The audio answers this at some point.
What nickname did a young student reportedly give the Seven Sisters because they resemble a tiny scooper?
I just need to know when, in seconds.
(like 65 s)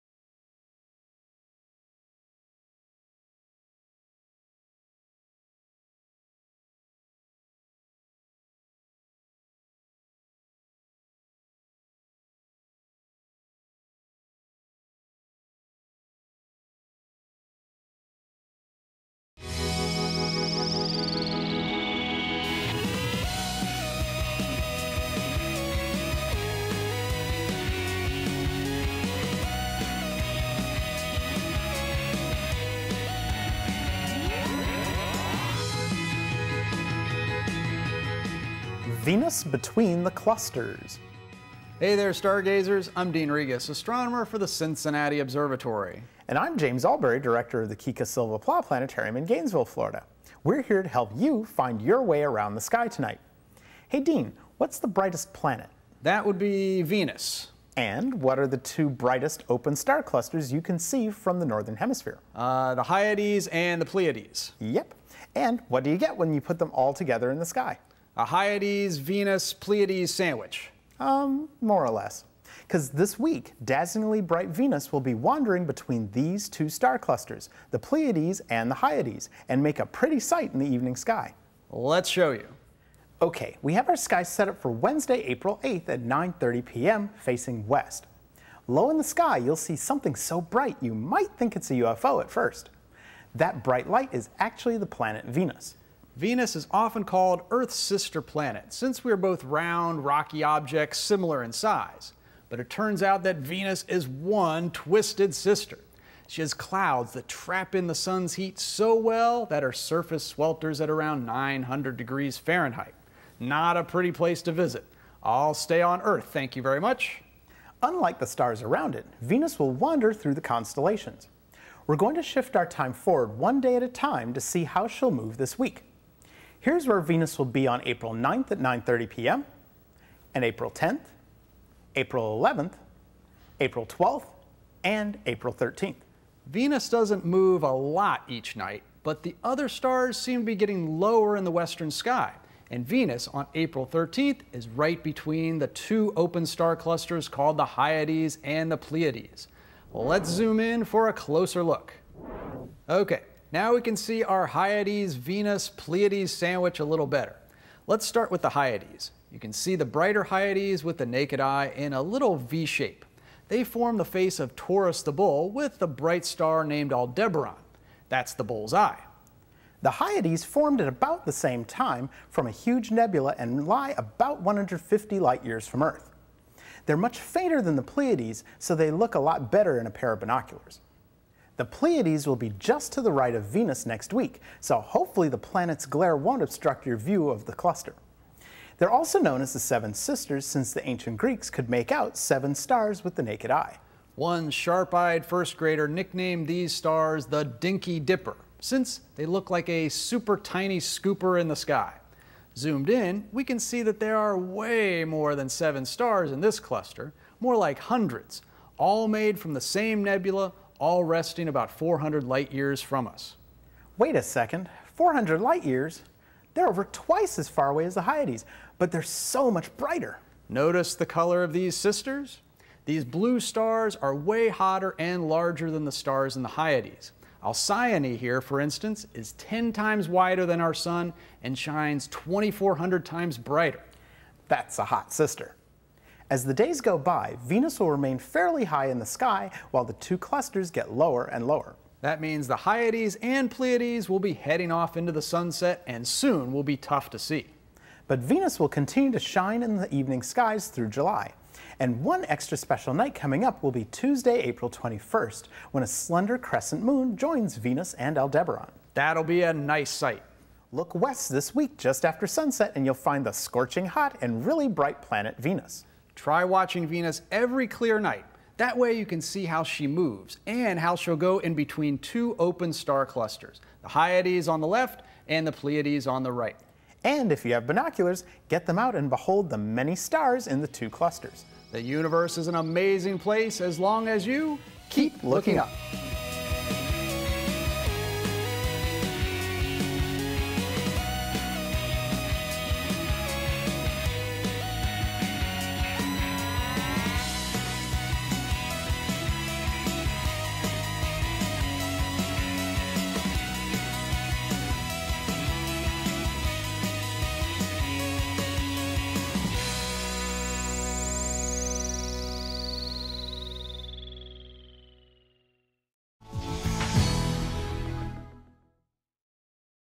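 197 s.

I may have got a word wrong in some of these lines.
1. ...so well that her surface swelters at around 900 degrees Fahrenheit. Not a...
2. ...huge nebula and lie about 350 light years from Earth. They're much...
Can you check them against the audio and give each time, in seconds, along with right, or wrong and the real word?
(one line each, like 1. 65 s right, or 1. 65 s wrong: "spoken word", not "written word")
1. 108 s right
2. 172 s wrong: "150", not "350".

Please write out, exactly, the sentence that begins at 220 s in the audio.
Notice the color of these sisters?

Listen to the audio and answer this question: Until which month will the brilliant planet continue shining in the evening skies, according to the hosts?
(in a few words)
July.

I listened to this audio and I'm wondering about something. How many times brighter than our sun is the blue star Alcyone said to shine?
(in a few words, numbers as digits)
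2,400.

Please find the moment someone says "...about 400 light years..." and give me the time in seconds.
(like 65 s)
211 s.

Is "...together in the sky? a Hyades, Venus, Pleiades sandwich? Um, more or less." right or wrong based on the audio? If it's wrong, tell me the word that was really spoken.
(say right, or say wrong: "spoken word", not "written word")
right.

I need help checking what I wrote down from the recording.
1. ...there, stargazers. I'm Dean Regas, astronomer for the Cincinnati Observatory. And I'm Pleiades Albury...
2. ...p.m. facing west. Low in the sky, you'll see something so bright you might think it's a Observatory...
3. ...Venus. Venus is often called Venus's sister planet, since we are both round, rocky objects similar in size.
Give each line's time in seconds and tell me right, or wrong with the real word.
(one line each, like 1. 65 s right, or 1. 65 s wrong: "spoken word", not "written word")
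1. 41 s wrong: "James", not "Pleiades"
2. 86 s wrong: "UFO", not "Observatory"
3. 95 s wrong: "Earth", not "Venus".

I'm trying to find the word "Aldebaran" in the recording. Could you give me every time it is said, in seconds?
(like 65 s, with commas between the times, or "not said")
166 s, 258 s.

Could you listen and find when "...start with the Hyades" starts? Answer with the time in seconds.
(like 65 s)
158 s.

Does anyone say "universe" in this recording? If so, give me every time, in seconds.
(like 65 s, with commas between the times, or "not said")
281 s.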